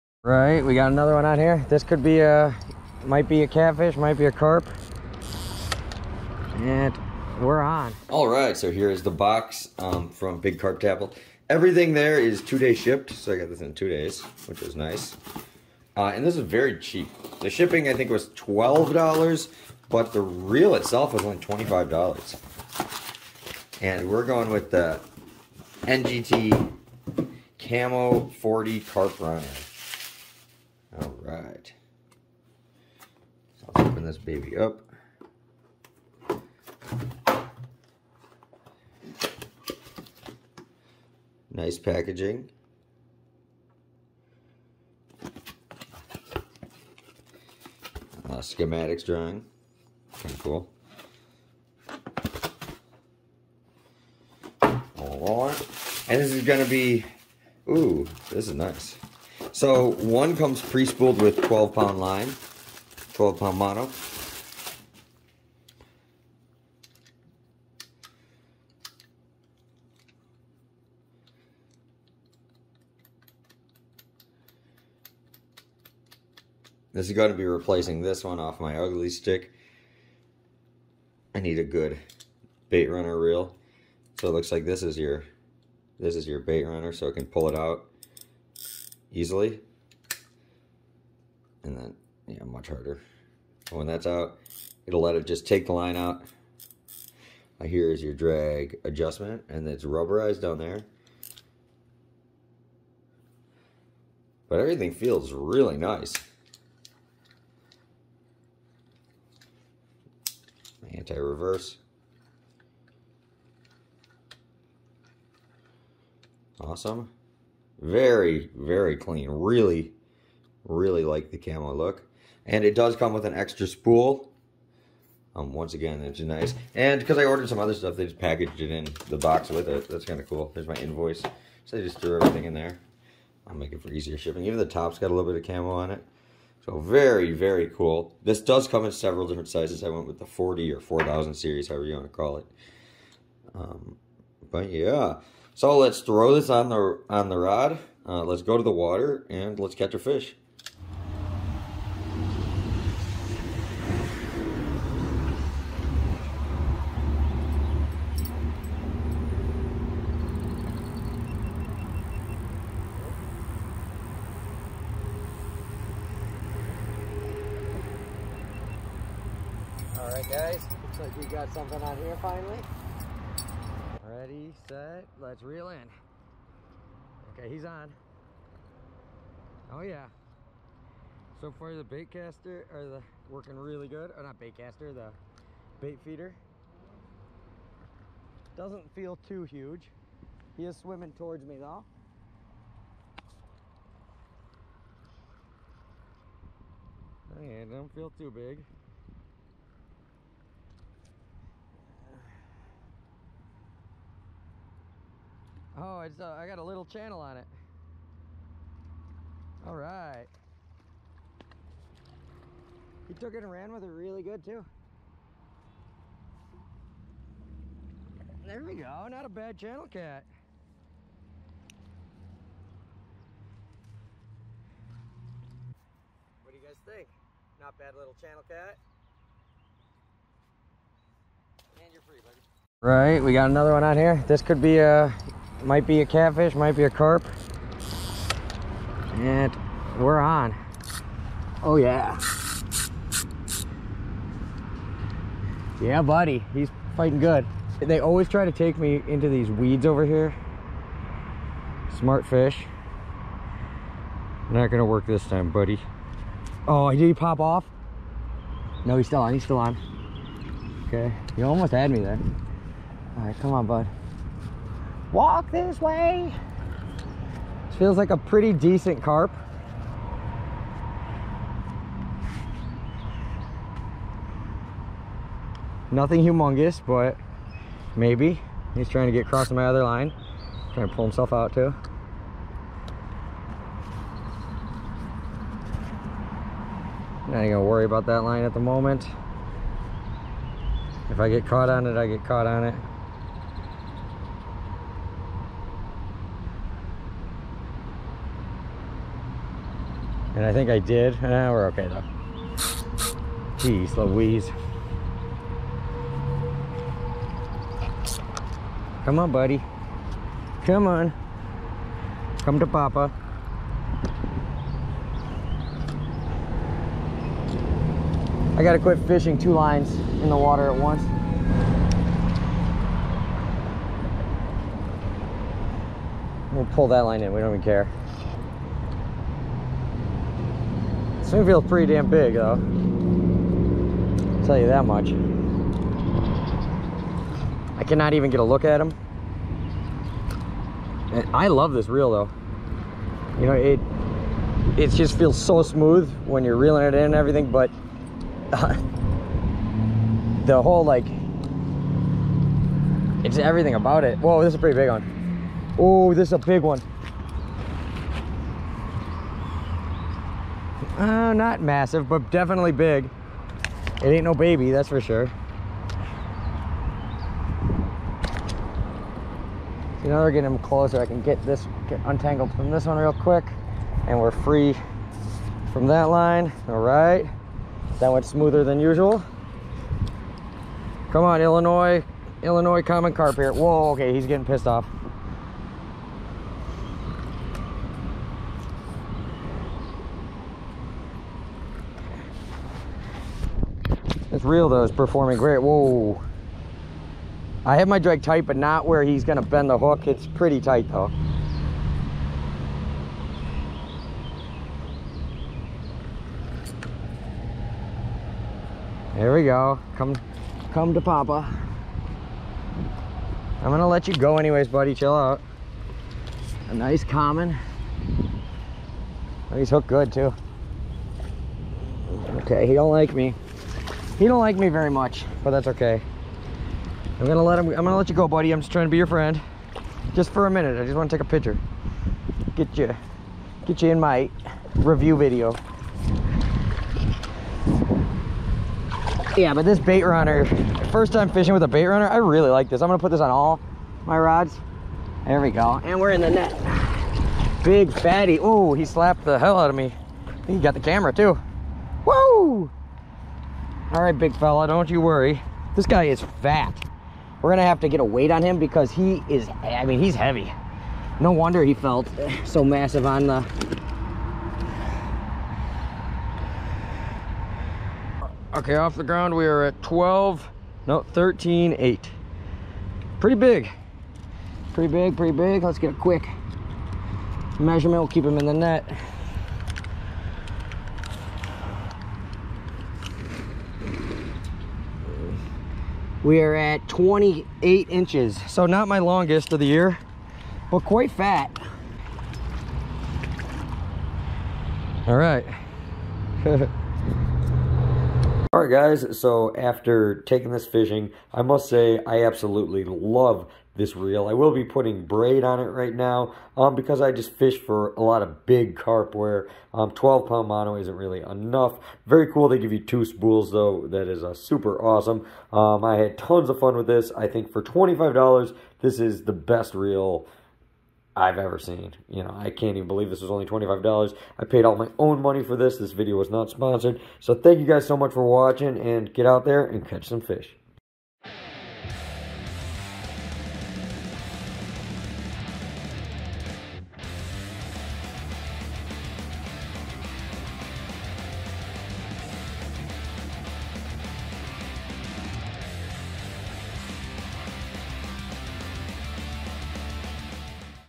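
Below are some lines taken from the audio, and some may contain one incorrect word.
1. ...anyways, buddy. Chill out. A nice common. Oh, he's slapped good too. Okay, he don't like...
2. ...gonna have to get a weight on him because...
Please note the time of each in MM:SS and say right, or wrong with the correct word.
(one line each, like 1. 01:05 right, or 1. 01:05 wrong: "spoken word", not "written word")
1. 06:54 wrong: "hooked", not "slapped"
2. 07:37 right.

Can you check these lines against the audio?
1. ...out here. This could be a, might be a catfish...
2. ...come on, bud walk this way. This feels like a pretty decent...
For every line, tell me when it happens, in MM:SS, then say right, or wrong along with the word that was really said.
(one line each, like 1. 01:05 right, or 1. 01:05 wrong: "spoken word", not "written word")
1. 00:01 right
2. 04:23 right.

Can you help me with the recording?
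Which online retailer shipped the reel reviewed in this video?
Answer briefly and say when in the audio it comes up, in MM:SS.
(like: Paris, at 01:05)
Big Carp Tackle, at 00:10.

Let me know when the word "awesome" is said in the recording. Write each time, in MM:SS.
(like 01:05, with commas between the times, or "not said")
01:56, 08:34.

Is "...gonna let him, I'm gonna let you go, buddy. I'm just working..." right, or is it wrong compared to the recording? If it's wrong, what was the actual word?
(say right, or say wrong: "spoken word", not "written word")
wrong: "trying", not "working".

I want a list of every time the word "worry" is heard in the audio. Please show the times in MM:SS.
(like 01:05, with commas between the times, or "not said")
04:47, 07:35.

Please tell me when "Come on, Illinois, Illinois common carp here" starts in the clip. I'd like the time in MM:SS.
06:21.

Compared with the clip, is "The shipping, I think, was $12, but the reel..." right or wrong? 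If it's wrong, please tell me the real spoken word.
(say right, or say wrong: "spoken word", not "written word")
right.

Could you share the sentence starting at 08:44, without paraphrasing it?
I paid all my own money for this.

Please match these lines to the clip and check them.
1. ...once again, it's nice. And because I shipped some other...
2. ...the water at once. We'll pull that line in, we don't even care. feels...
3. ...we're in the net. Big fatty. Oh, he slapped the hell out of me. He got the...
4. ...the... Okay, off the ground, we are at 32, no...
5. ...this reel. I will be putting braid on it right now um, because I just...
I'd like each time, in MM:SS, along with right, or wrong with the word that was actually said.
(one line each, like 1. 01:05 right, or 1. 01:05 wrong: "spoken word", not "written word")
1. 02:05 wrong: "ordered", not "shipped"
2. 05:20 right
3. 07:25 right
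4. 07:43 wrong: "12", not "32"
5. 08:23 right.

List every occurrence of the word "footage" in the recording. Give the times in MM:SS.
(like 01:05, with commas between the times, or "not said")
not said.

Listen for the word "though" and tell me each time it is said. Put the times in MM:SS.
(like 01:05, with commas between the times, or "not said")
03:11, 05:01, 05:32, 05:42, 06:34, 06:40, 08:33.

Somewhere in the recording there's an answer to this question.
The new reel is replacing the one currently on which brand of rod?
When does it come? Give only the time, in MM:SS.
01:18.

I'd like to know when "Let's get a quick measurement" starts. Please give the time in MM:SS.
07:55.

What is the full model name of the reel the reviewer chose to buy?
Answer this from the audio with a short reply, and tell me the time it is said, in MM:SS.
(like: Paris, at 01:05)
NGT Camo 40 Carp Runner, at 00:25.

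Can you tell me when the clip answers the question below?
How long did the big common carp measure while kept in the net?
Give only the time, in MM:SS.
08:06.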